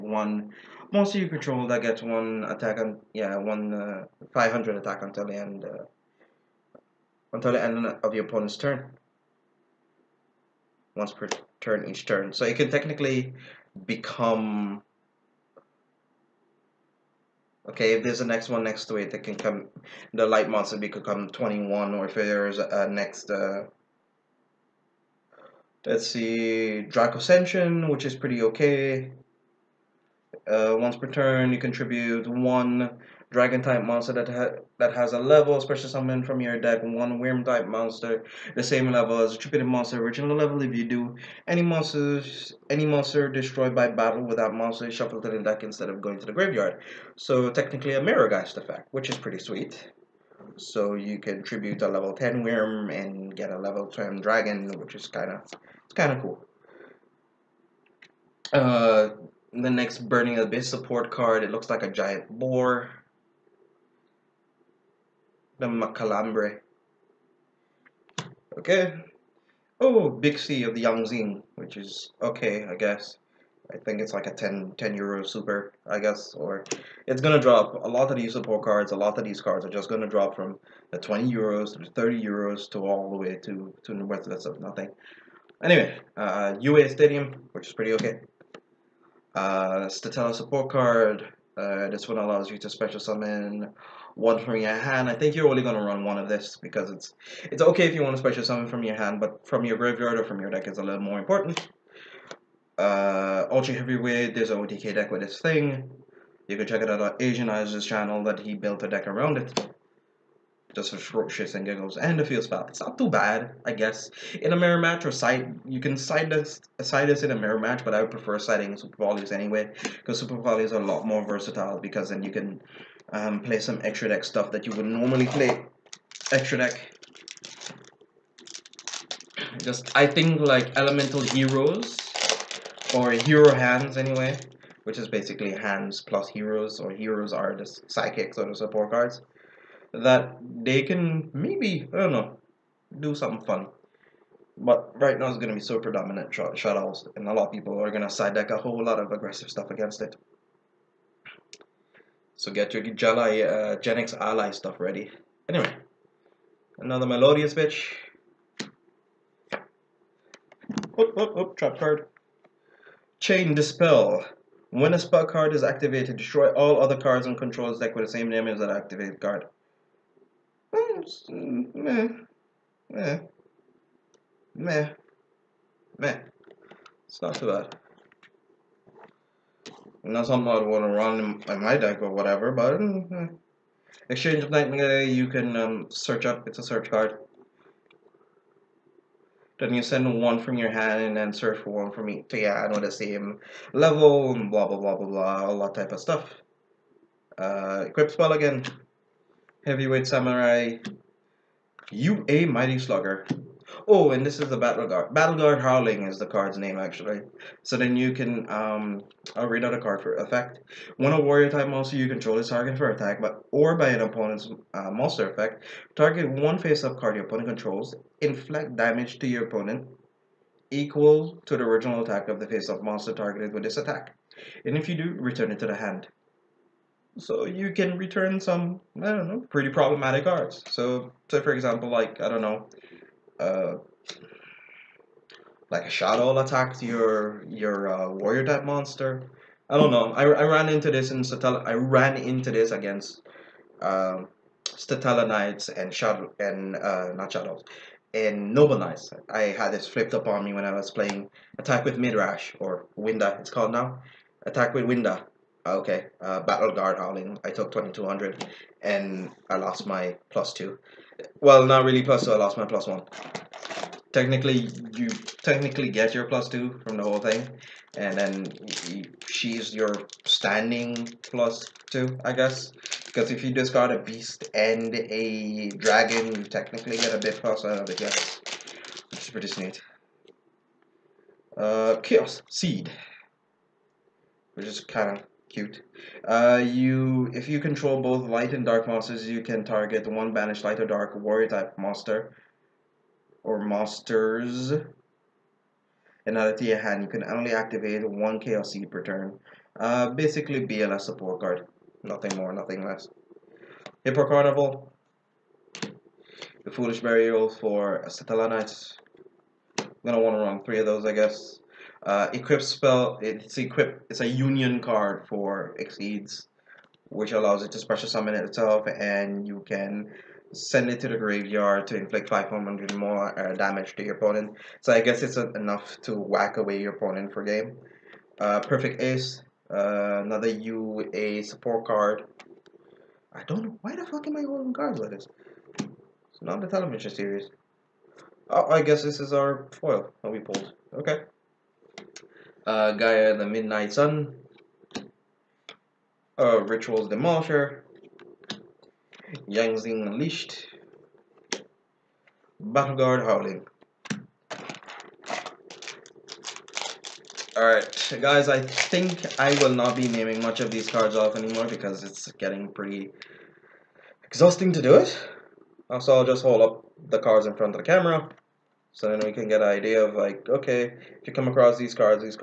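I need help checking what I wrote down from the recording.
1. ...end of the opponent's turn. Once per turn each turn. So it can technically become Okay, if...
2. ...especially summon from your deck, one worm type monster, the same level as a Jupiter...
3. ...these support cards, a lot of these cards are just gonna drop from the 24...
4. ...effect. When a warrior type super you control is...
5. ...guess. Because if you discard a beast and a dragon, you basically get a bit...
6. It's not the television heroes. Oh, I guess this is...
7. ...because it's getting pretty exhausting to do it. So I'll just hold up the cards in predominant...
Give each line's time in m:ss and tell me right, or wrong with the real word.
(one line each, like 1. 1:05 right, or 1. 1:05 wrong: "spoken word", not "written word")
1. 0:07 right
2. 0:35 right
3. 1:18 wrong: "20", not "24"
4. 3:30 wrong: "monster", not "super"
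5. 4:32 wrong: "technically", not "basically"
6. 5:35 wrong: "series", not "heroes"
7. 6:01 wrong: "front", not "predominant".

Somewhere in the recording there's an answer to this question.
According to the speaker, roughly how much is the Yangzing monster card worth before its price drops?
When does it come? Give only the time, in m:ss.
1:14.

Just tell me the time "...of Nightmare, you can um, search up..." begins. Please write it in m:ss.
3:04.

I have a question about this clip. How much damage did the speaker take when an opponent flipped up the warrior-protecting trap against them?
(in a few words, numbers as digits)
2200.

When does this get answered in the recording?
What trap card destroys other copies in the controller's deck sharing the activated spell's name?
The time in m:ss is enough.
2:43.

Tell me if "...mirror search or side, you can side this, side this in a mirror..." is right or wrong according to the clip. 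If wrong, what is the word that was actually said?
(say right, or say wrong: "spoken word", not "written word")
wrong: "match", not "search".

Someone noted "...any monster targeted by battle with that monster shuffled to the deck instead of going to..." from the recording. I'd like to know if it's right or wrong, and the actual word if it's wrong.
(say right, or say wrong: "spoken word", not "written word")
wrong: "destroyed", not "targeted".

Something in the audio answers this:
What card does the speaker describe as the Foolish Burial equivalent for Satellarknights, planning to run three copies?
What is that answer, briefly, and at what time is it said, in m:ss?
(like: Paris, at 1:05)
Hippo Carnival, at 5:04.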